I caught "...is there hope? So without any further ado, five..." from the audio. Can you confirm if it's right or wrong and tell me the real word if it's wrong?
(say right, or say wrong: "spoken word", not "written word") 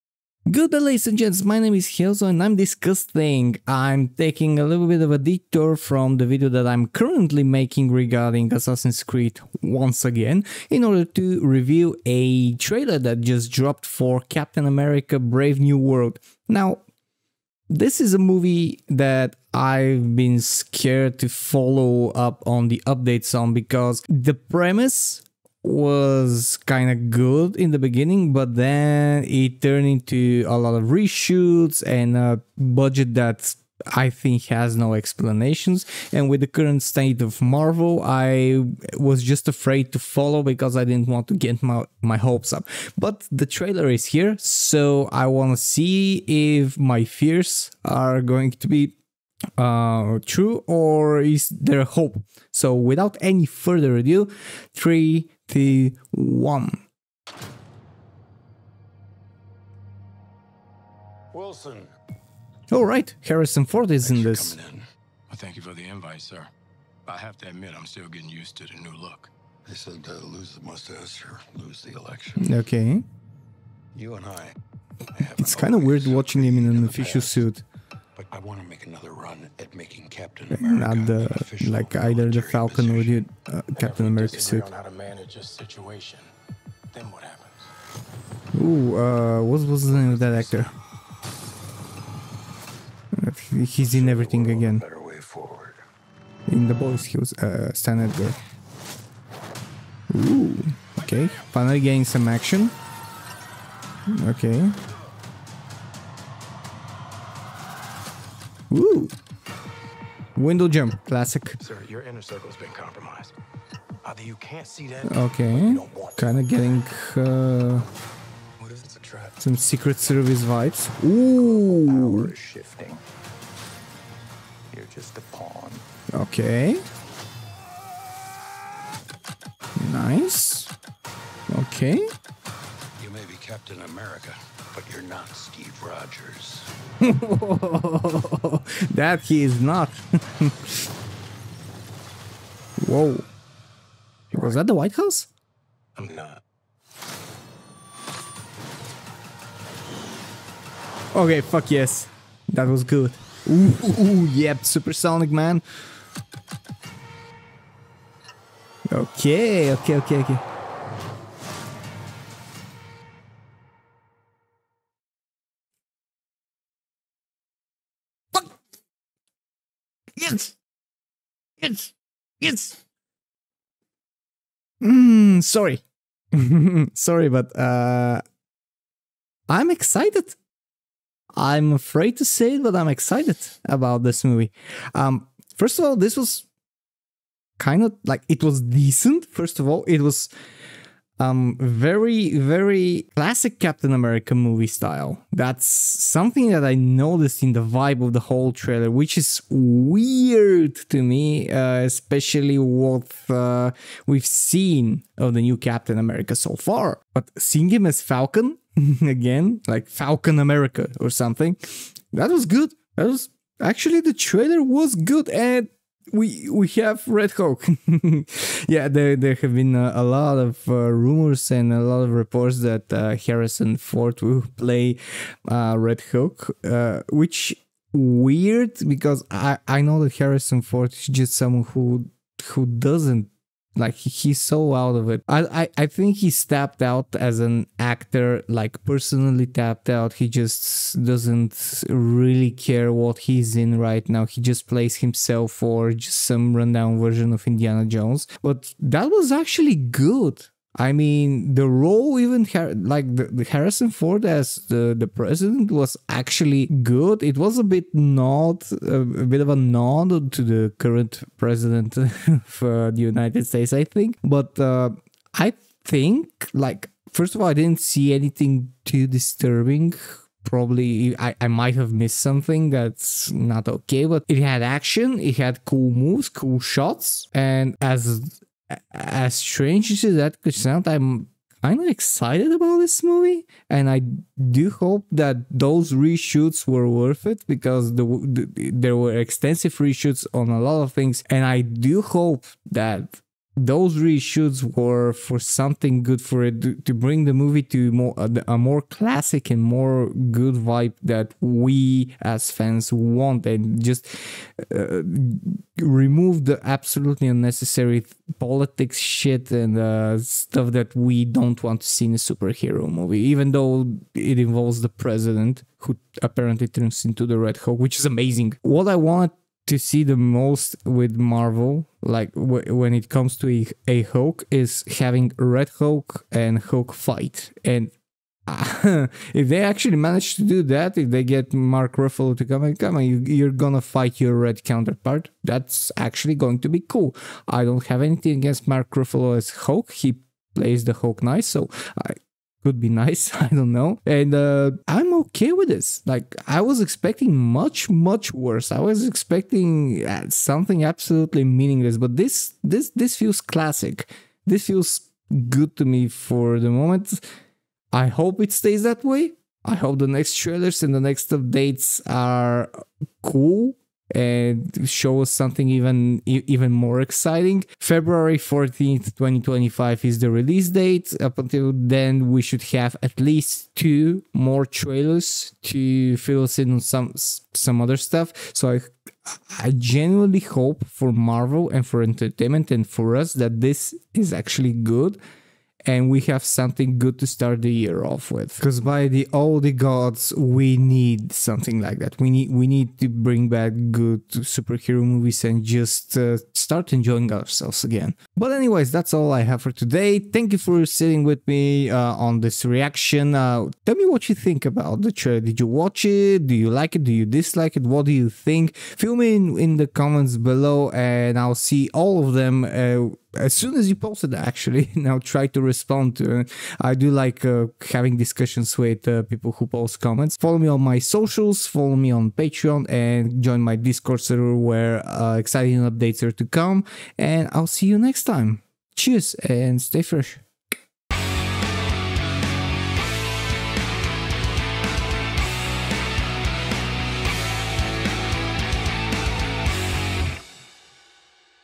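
wrong: "three", not "five".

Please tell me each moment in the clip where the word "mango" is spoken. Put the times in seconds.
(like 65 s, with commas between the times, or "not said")
not said.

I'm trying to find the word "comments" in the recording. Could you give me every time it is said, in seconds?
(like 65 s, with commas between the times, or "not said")
409 s, 420 s.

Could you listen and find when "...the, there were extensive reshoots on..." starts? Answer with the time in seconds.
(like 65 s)
288 s.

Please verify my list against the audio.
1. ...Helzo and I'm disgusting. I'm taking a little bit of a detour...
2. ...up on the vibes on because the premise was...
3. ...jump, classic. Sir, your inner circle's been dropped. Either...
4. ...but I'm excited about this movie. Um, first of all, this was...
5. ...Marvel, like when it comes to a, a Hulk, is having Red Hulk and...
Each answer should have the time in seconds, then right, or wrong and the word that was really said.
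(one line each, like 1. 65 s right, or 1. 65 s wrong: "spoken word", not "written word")
1. 1 s right
2. 22 s wrong: "updates", not "vibes"
3. 110 s wrong: "compromised", not "dropped"
4. 182 s right
5. 321 s right.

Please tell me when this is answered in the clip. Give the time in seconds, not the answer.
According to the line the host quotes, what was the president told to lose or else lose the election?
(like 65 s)
70 s.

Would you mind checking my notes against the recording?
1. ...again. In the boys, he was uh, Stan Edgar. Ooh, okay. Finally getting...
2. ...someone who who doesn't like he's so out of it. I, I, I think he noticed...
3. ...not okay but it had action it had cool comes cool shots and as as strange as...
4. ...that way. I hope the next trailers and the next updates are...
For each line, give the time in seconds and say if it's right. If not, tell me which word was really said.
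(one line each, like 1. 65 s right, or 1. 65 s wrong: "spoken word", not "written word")
1. 94 s right
2. 231 s wrong: "tapped", not "noticed"
3. 273 s wrong: "moves", not "comes"
4. 358 s right.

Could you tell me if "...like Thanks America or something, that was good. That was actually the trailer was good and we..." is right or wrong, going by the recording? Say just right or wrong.
wrong.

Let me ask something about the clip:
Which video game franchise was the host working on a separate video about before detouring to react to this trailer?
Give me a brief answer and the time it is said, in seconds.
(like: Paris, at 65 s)
Assassin's Creed, at 8 s.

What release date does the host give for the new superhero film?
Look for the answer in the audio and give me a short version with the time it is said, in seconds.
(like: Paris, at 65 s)
February 14th, 2025, at 367 s.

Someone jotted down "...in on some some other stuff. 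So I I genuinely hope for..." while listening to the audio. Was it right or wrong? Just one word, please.
right.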